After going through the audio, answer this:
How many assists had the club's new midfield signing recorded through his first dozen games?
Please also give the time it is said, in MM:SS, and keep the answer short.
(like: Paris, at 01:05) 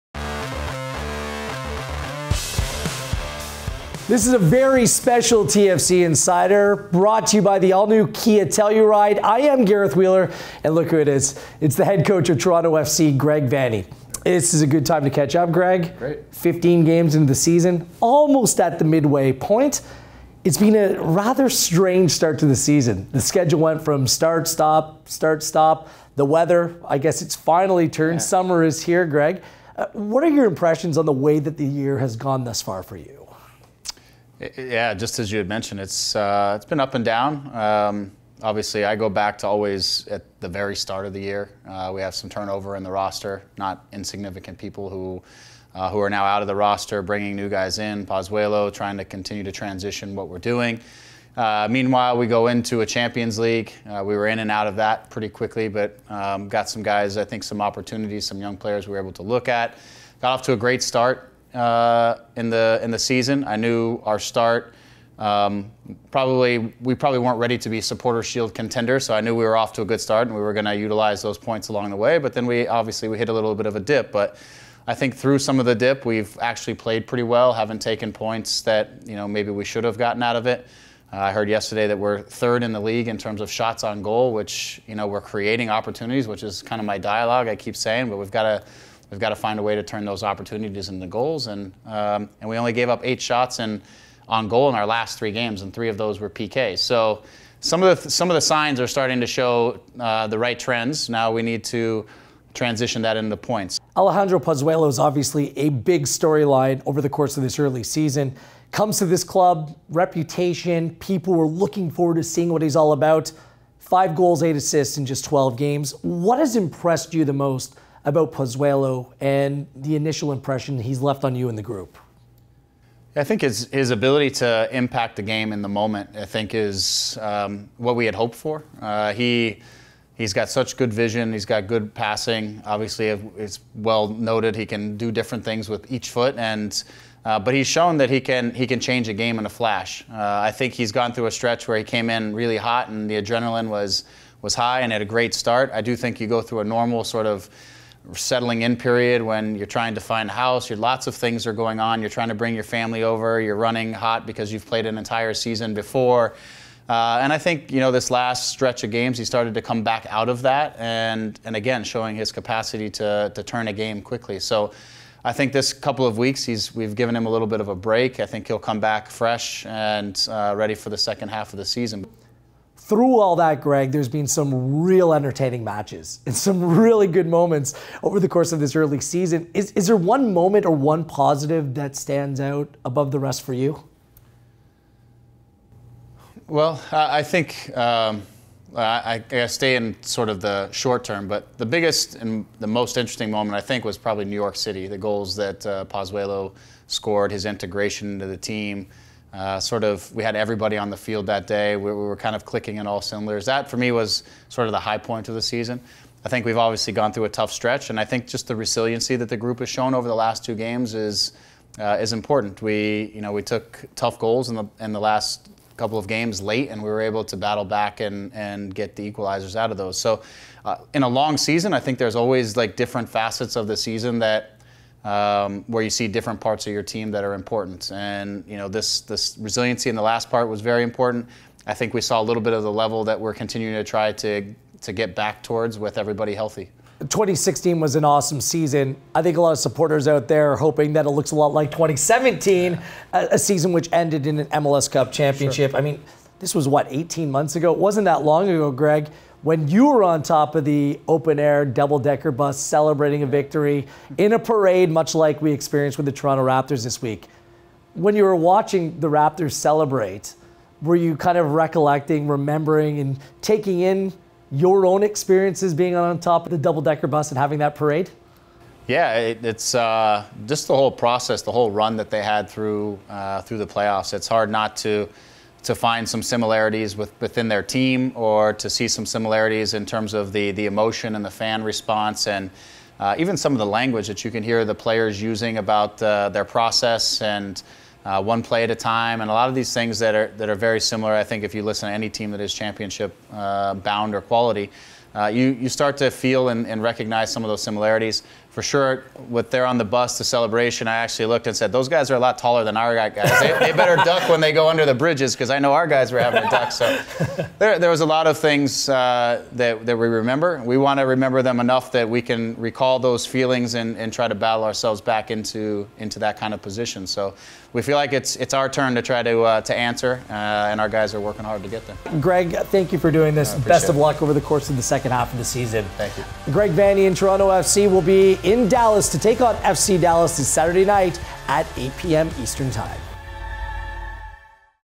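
8, at 01:54.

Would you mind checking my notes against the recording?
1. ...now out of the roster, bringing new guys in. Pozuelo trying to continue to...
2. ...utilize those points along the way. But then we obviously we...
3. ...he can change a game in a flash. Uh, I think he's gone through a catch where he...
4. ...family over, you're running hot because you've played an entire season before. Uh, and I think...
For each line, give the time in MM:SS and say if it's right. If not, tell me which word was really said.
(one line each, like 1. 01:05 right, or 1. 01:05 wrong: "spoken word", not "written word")
1. 00:46 right
2. 01:10 right
3. 02:18 wrong: "stretch", not "catch"
4. 02:32 right.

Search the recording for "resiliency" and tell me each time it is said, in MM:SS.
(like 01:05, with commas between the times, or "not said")
03:28, 03:49.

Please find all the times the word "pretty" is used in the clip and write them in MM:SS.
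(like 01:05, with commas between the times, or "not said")
00:55, 01:17.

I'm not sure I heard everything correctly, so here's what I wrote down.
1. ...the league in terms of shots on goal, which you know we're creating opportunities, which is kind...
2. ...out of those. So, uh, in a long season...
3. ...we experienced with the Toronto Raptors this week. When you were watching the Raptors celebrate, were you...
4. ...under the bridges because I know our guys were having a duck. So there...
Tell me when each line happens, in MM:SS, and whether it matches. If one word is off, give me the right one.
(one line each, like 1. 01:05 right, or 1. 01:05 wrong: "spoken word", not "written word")
1. 01:22 right
2. 03:39 right
3. 04:15 right
4. 05:04 right.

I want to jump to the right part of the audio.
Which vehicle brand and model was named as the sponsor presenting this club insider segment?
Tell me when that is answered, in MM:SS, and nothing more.
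00:08.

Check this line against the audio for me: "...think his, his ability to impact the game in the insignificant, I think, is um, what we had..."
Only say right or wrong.
wrong.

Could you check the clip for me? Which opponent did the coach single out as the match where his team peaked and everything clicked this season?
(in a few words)
New York City.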